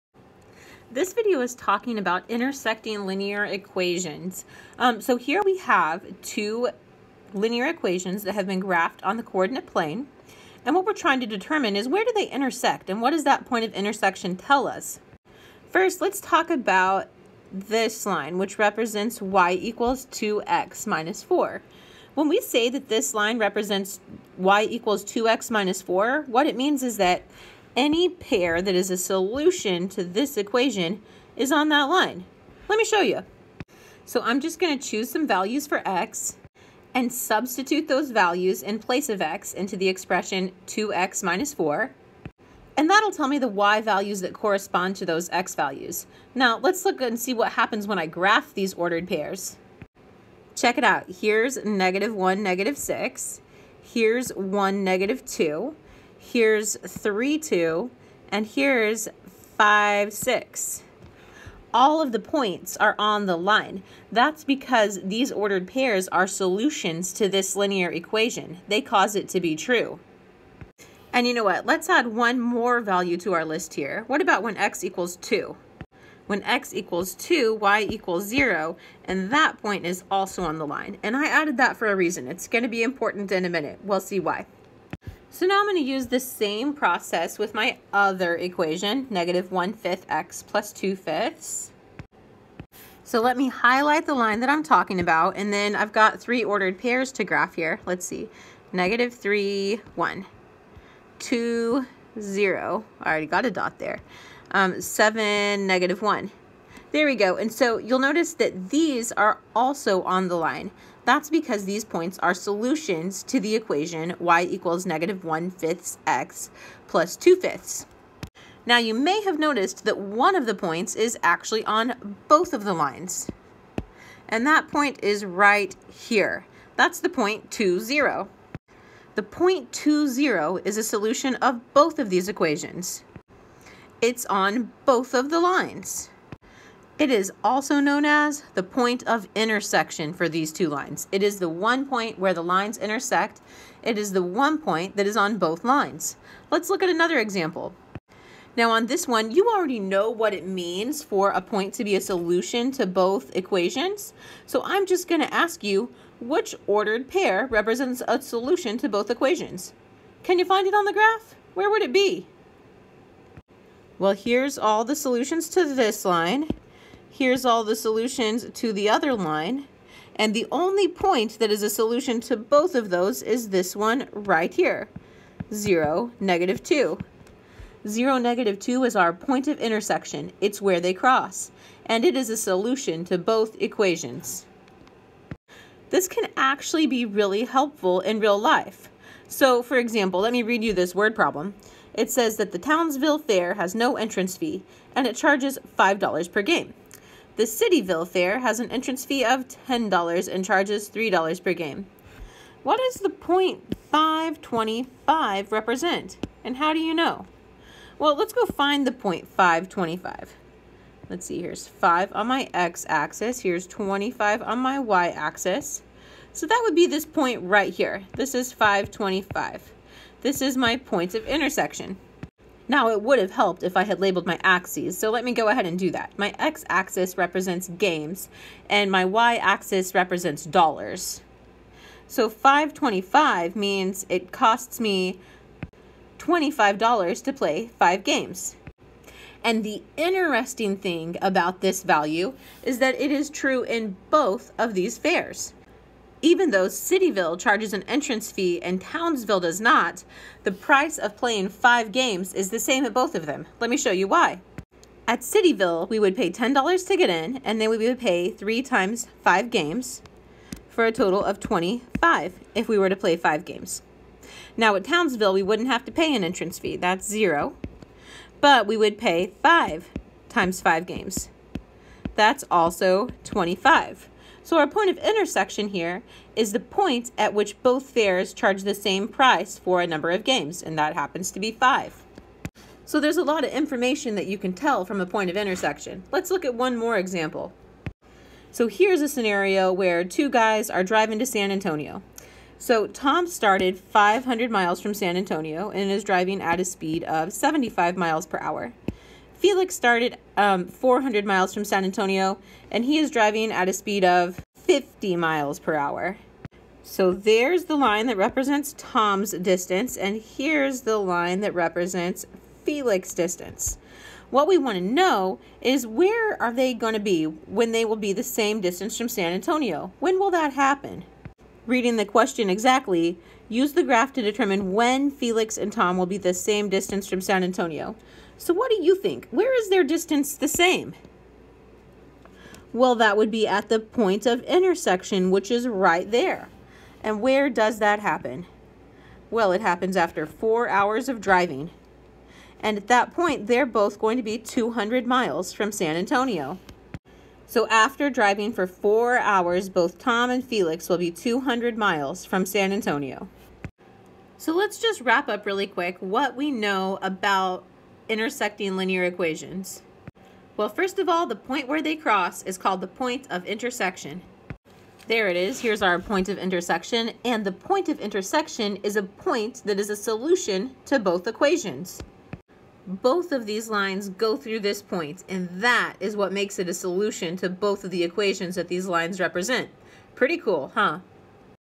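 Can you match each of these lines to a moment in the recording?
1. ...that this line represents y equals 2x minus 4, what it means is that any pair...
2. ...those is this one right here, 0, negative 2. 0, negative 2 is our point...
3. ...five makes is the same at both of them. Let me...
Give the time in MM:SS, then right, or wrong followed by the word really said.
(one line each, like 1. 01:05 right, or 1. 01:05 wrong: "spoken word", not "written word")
1. 00:22 right
2. 02:52 right
3. 04:11 wrong: "games", not "makes".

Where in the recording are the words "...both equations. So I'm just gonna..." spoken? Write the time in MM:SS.
02:32.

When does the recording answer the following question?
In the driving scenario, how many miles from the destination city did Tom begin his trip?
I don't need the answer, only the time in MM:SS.
04:53.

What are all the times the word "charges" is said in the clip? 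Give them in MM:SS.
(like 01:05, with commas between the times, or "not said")
03:15, 03:20, 04:07, 04:38.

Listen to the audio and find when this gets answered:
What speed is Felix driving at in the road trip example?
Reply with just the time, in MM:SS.
05:04.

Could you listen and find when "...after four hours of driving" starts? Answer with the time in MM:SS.
05:39.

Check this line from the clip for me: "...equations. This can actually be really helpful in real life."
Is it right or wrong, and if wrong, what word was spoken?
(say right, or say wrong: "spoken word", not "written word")
right.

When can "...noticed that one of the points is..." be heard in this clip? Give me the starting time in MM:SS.
01:59.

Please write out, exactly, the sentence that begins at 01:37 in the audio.
Let's see, negative 3, 1, 2, 0.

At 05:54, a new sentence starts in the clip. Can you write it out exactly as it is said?
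So let's just wrap up really quick what we know about intersecting linear equations?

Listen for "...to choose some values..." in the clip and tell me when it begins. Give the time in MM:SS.
00:34.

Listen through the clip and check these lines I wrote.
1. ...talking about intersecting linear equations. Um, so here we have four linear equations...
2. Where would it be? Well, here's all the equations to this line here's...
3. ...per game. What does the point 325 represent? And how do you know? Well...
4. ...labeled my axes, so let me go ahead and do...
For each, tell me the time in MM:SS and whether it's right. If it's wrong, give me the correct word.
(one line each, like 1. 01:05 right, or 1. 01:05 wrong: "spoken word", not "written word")
1. 00:01 wrong: "two", not "four"
2. 02:41 wrong: "solutions", not "equations"
3. 03:21 wrong: "525", not "325"
4. 03:43 right.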